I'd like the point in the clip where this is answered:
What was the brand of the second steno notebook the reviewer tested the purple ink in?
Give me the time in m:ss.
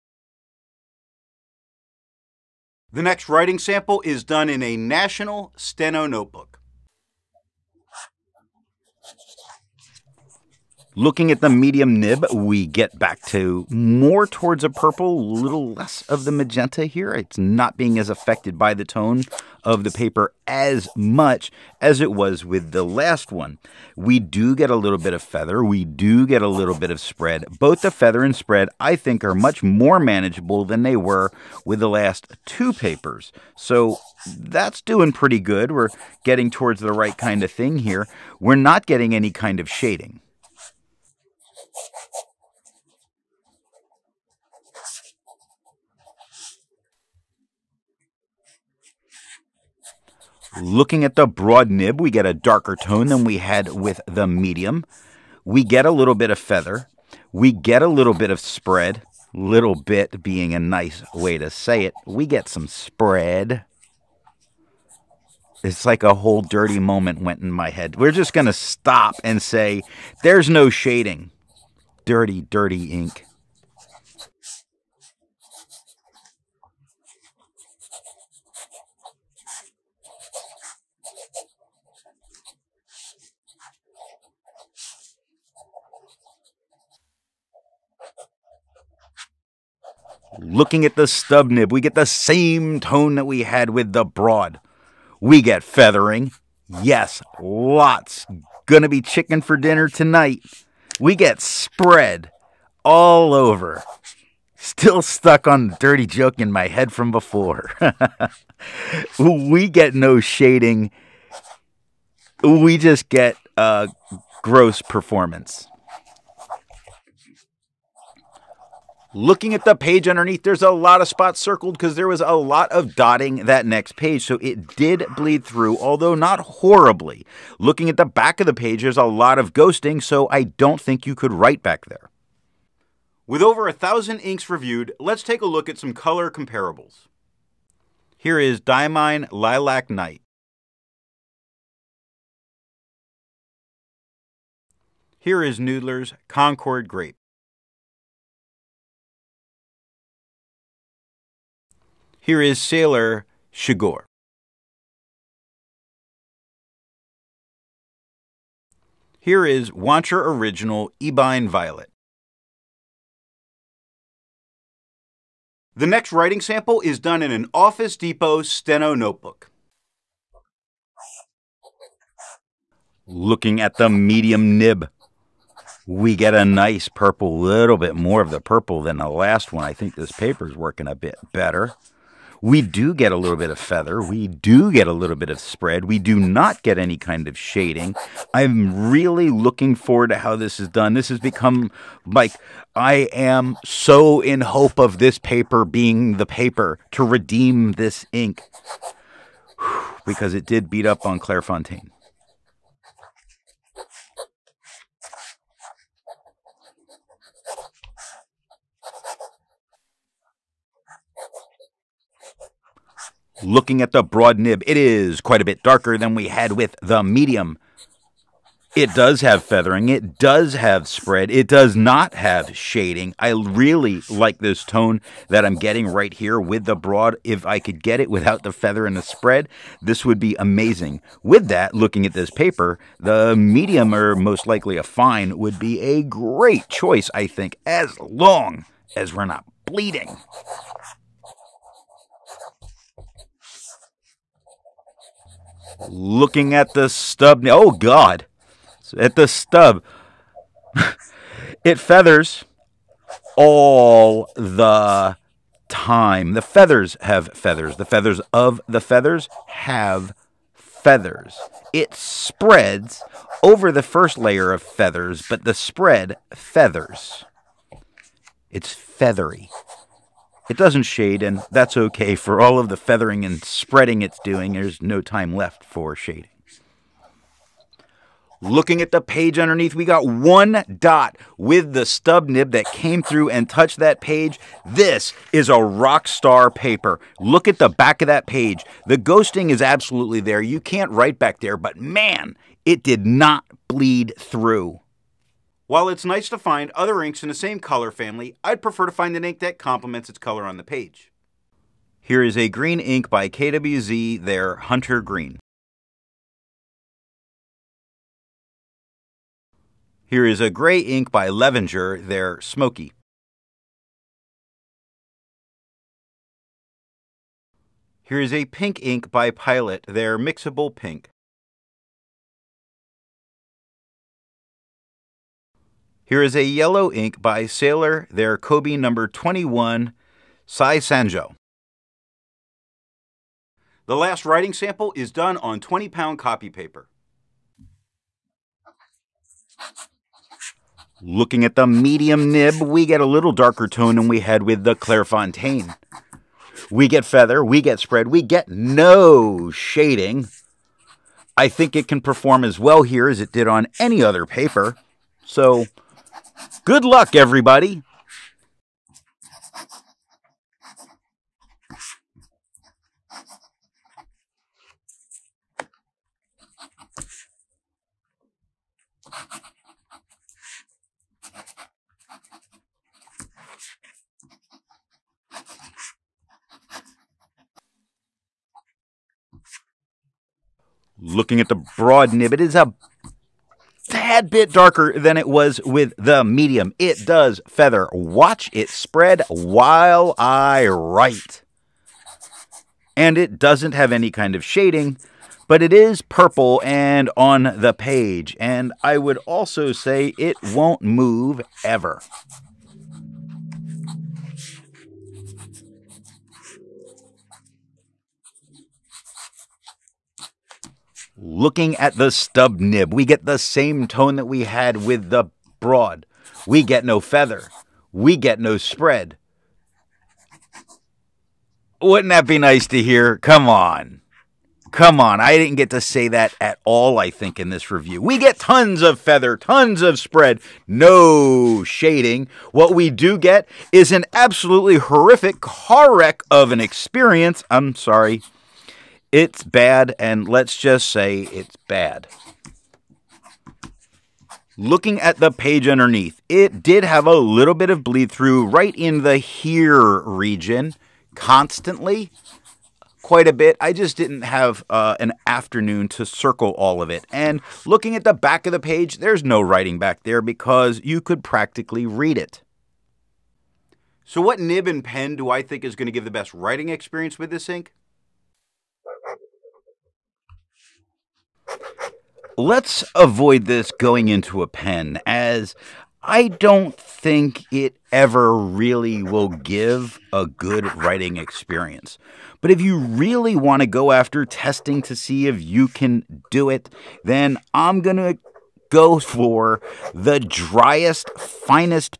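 2:47.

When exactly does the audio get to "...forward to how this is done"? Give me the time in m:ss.
3:09.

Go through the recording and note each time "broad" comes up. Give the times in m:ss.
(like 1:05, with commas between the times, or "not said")
0:51, 1:34, 3:34, 3:46, 6:21, 6:55.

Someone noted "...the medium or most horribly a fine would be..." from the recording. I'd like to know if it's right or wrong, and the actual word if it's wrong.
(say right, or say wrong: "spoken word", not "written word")
wrong: "likely", not "horribly".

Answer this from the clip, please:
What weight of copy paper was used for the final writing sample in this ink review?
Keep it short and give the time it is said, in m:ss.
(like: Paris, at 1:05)
20 pound, at 5:35.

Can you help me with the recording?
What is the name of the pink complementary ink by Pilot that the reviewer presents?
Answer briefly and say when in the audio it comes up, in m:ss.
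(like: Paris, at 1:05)
Mixable Pink, at 5:20.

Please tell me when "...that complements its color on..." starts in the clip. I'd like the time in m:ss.
4:59.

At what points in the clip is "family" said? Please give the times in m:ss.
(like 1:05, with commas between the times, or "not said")
4:57.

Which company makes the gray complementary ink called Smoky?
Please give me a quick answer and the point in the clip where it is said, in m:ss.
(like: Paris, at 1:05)
Levenger, at 5:11.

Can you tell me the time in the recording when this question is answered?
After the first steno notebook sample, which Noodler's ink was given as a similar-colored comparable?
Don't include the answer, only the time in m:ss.
2:25.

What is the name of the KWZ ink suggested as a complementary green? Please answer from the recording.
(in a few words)
Hunter Green.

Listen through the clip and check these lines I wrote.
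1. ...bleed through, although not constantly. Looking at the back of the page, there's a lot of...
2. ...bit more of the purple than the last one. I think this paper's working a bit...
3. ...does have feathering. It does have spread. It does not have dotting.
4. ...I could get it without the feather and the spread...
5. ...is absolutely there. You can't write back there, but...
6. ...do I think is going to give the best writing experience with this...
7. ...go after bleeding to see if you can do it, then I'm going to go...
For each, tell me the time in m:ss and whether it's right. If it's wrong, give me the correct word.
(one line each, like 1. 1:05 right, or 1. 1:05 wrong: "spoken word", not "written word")
1. 2:05 wrong: "horribly", not "constantly"
2. 2:57 right
3. 3:38 wrong: "shading", not "dotting"
4. 3:47 right
5. 4:49 right
6. 7:45 right
7. 8:03 wrong: "testing", not "bleeding".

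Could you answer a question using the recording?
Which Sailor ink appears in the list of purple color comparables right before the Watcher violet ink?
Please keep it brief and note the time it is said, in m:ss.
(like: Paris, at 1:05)
Shigure, at 2:32.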